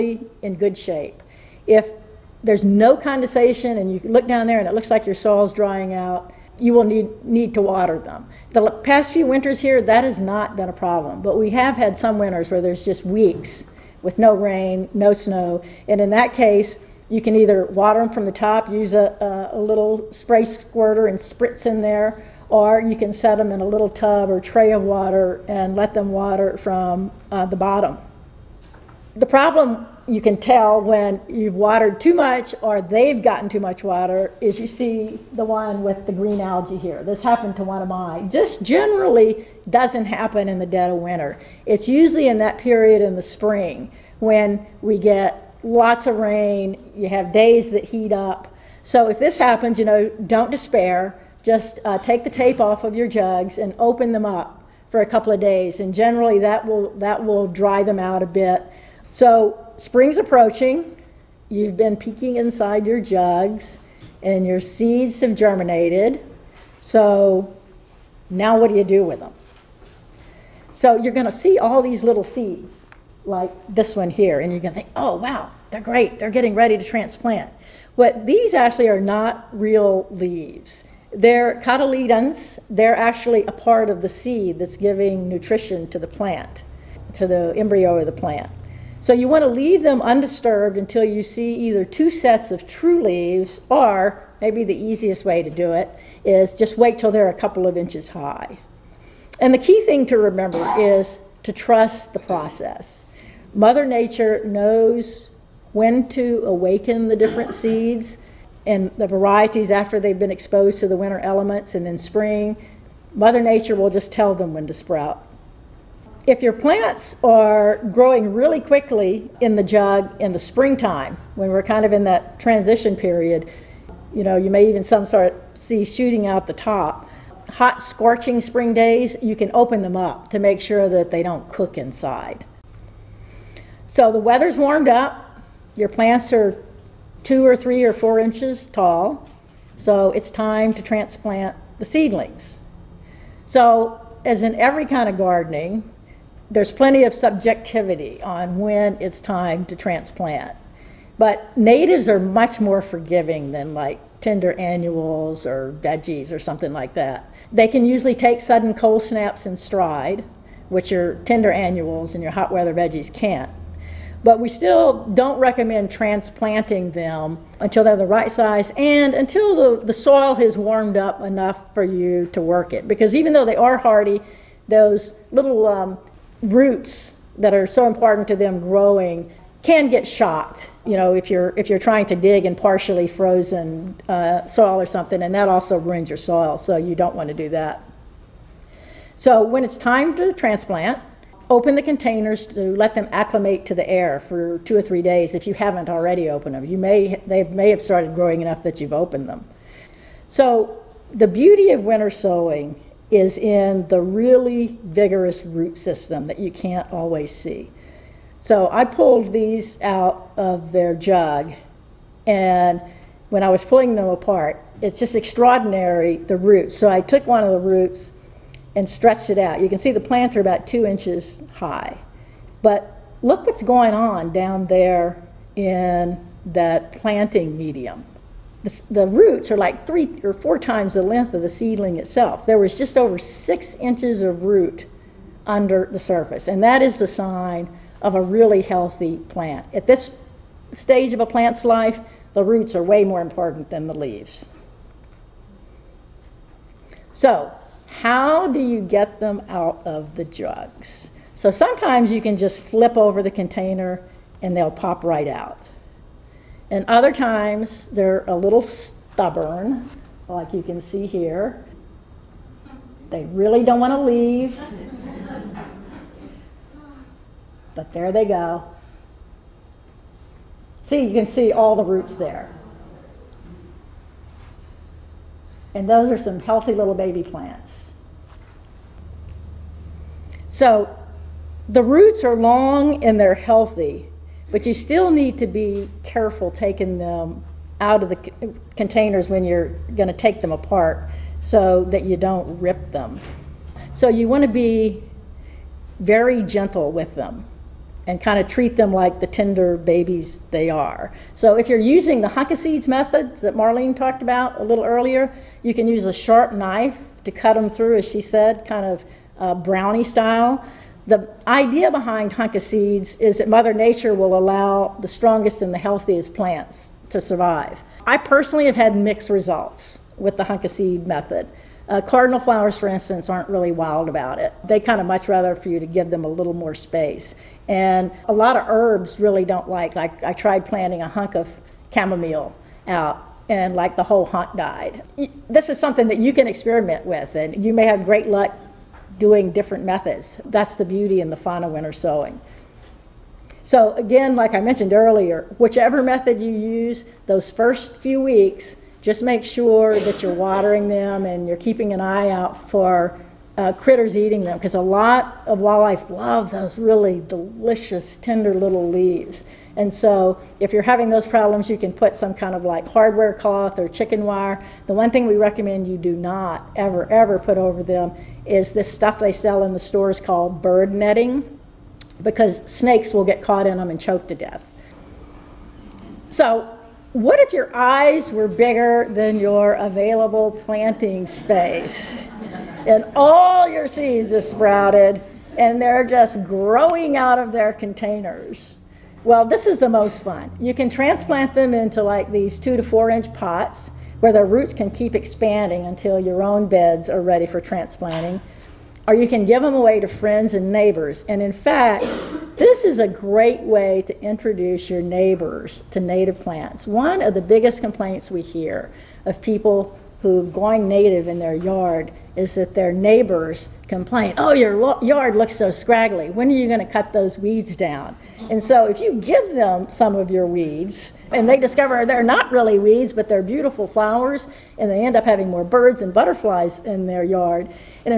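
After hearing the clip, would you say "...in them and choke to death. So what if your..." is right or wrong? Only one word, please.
right.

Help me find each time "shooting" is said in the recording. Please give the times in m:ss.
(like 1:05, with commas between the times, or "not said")
2:05.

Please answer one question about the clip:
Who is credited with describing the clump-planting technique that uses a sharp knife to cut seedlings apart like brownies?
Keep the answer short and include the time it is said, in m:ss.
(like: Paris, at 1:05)
Marlene, at 5:03.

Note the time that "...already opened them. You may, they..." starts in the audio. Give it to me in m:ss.
3:15.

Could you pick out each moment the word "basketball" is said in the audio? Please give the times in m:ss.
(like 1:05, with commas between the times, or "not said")
not said.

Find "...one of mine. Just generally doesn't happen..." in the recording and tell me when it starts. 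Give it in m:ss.
0:37.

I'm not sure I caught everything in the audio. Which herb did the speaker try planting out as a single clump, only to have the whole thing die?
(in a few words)
chamomile.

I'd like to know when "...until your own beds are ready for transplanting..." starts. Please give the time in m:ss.
6:35.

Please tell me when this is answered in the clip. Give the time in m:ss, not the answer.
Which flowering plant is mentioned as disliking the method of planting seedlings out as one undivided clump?
5:21.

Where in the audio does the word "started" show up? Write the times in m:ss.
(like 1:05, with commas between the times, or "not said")
3:17.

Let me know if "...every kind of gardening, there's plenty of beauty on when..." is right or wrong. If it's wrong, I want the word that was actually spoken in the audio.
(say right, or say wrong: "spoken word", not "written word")
wrong: "subjectivity", not "beauty".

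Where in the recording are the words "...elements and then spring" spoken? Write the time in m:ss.
1:51.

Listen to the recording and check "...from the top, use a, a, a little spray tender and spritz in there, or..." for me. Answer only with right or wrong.
wrong.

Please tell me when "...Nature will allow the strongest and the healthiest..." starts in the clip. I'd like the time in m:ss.
5:13.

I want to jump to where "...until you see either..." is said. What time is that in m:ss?
1:30.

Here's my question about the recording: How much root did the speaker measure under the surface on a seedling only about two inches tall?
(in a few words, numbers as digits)
just over 6 inches.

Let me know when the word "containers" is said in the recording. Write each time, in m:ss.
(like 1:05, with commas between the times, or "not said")
3:11, 4:13, 4:48, 6:27.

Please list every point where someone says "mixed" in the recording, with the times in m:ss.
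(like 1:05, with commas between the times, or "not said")
5:18.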